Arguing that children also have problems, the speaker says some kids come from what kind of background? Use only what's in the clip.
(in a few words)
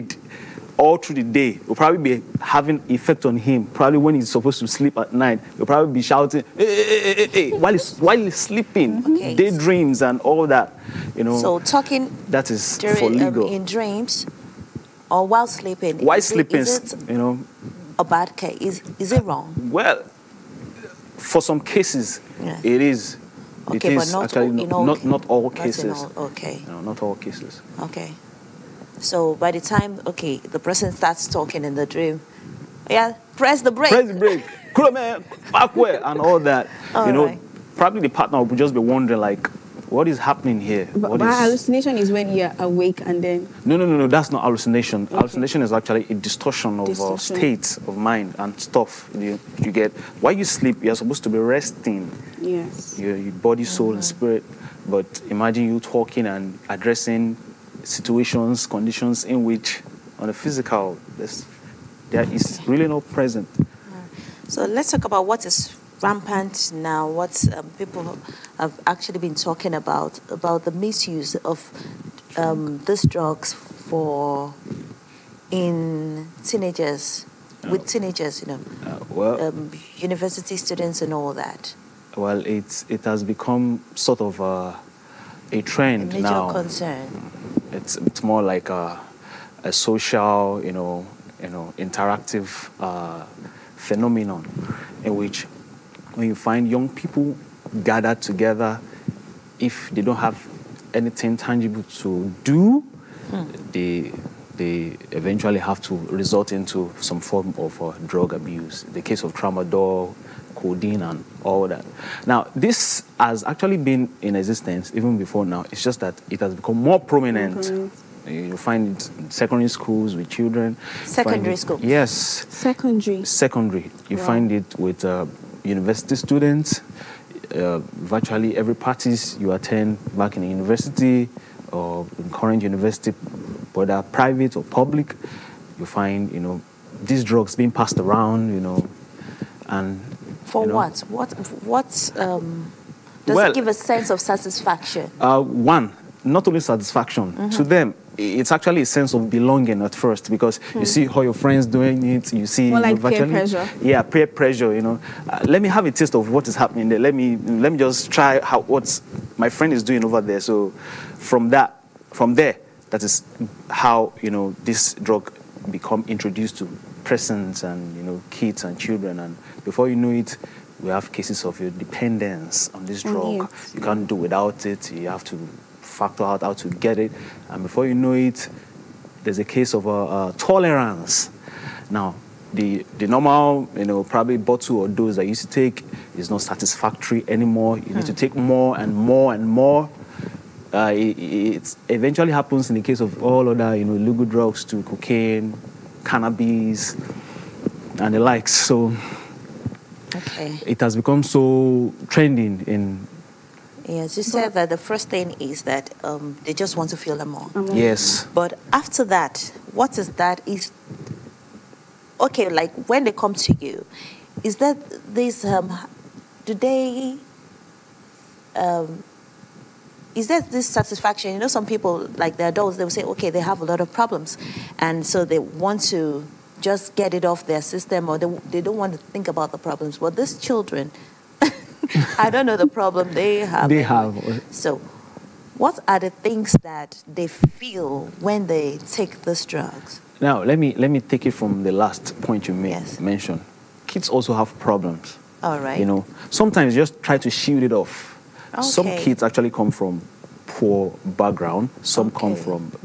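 poor background.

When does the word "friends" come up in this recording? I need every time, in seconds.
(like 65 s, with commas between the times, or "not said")
151 s, 159 s.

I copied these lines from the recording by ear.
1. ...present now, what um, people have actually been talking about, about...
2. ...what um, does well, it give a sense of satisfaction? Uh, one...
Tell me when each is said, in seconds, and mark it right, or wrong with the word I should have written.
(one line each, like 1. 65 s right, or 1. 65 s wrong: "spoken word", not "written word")
1. 66 s wrong: "rampant", not "present"
2. 141 s right.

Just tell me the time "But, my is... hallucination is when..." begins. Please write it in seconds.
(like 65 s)
40 s.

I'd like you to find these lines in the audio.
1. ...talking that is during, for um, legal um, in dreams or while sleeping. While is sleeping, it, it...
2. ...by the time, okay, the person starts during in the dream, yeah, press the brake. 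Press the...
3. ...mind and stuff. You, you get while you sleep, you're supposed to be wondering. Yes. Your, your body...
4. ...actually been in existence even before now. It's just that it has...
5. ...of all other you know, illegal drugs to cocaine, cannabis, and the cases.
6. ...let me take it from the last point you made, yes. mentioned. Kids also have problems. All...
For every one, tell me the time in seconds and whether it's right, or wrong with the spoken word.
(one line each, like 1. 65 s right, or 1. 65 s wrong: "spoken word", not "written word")
1. 11 s right
2. 29 s wrong: "talking", not "during"
3. 47 s wrong: "resting", not "wondering"
4. 113 s right
5. 192 s wrong: "likes", not "cases"
6. 240 s right.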